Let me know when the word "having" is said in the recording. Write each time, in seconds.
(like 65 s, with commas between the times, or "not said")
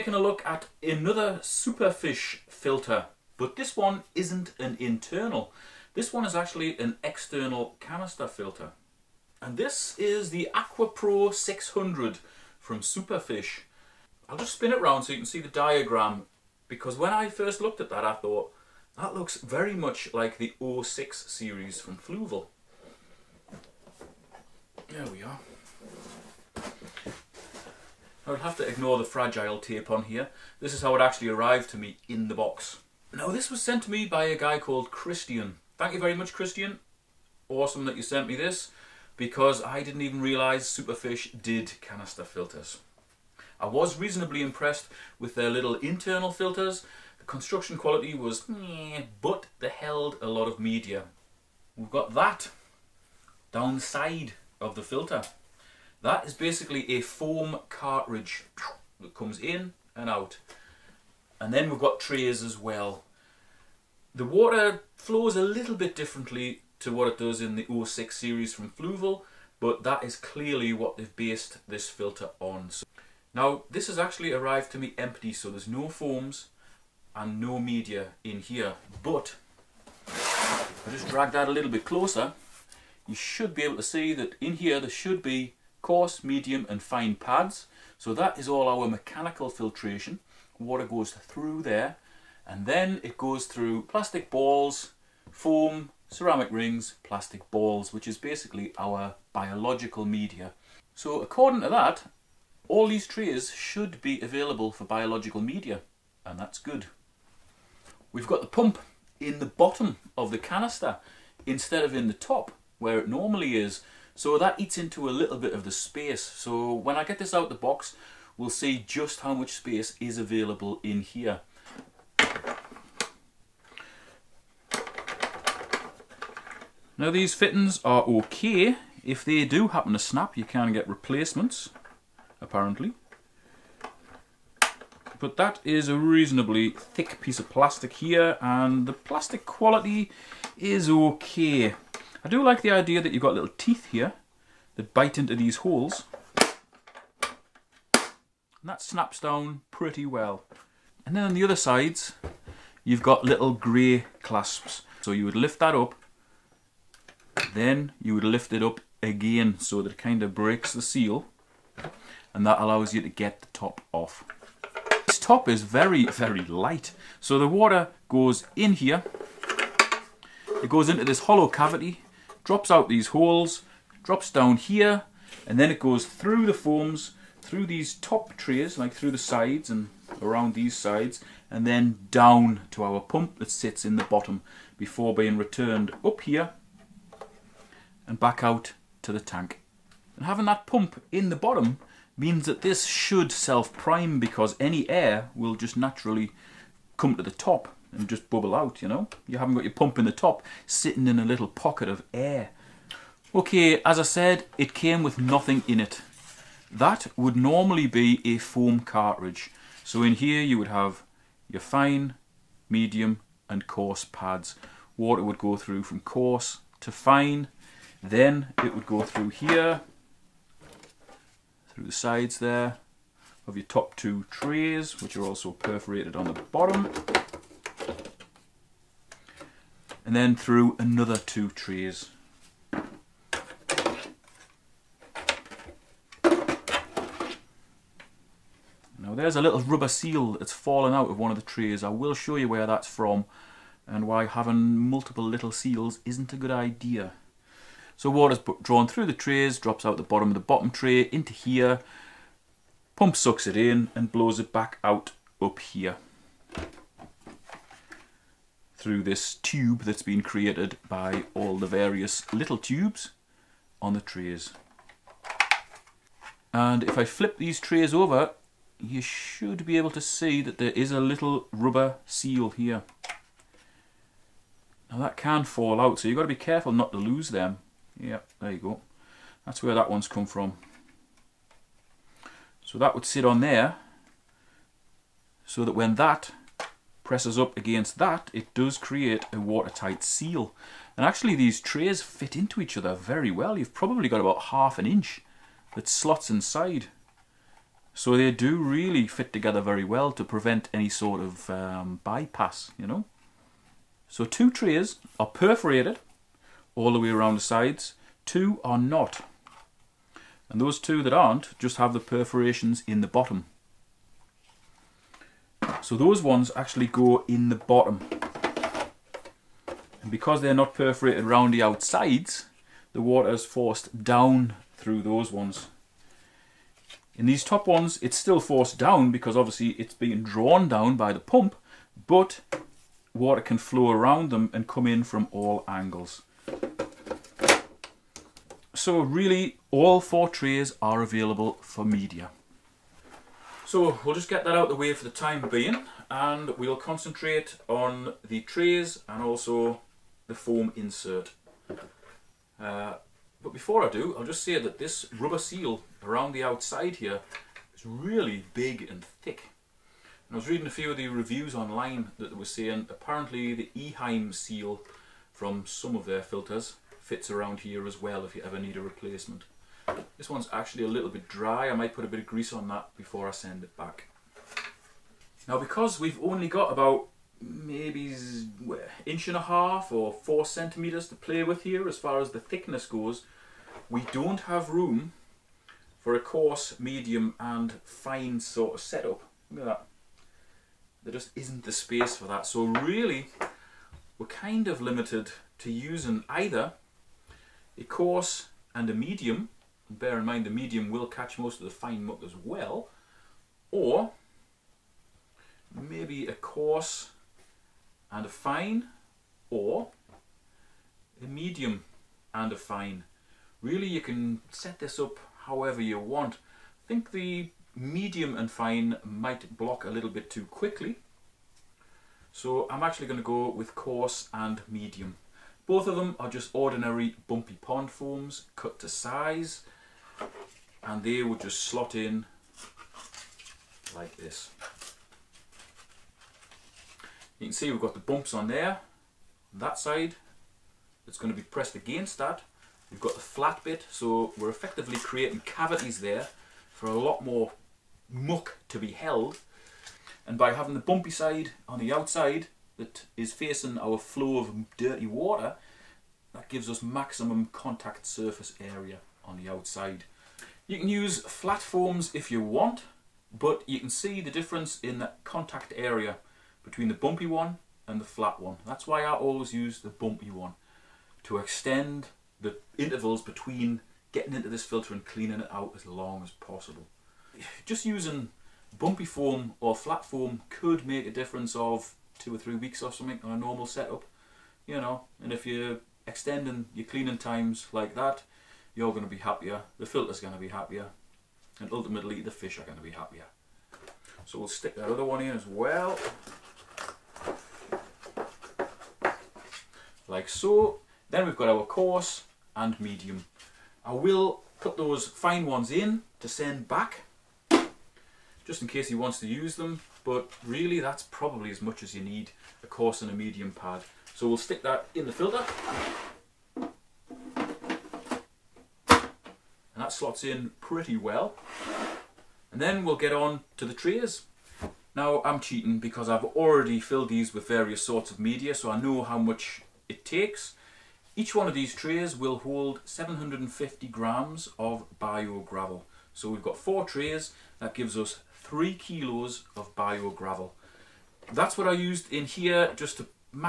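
190 s, 244 s, 450 s.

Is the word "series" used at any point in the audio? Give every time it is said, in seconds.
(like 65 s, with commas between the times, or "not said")
21 s, 68 s.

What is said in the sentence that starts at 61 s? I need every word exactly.
And then we've got trays as well.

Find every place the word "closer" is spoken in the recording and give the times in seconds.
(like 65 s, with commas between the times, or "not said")
81 s.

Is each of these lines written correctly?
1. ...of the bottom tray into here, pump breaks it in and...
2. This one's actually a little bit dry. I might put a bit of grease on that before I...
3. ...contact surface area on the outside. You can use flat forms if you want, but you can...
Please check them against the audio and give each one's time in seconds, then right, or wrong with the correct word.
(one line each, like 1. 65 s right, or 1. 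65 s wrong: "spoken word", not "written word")
1. 250 s wrong: "sucks", not "breaks"
2. 370 s right
3. 457 s right.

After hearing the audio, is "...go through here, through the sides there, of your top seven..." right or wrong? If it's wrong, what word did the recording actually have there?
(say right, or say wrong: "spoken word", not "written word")
wrong: "two", not "seven".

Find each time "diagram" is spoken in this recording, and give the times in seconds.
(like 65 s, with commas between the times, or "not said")
15 s.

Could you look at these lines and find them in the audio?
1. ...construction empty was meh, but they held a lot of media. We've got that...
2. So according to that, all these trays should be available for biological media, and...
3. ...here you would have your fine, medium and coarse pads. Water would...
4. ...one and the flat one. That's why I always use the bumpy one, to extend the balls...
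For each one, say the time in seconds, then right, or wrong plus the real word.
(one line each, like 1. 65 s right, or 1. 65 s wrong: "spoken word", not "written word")
1. 47 s wrong: "quality", not "empty"
2. 100 s right
3. 210 s right
4. 467 s wrong: "intervals", not "balls".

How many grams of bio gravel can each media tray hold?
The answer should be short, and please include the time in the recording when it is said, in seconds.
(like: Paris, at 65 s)
750, at 532 s.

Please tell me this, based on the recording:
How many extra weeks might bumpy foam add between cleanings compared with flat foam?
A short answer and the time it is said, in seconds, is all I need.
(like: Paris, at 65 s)
2 or 3, at 482 s.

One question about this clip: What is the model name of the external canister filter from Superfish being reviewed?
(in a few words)
AquaPro 600.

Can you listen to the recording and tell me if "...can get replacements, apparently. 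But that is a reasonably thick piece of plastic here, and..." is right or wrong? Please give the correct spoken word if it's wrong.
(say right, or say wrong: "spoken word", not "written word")
right.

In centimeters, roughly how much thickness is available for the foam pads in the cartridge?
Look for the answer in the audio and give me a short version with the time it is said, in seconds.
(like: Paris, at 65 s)
4, at 380 s.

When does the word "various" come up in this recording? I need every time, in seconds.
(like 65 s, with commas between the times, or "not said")
261 s, 527 s.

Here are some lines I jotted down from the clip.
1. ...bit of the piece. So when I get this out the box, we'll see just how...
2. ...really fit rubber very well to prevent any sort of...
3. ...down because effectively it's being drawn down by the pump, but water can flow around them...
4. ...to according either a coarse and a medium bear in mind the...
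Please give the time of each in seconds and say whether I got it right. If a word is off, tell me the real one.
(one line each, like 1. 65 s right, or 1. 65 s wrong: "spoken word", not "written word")
1. 115 s wrong: "space", not "piece"
2. 298 s wrong: "together", not "rubber"
3. 328 s wrong: "obviously", not "effectively"
4. 395 s wrong: "using", not "according".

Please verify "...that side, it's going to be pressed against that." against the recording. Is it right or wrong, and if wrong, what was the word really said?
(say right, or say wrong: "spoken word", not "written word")
right.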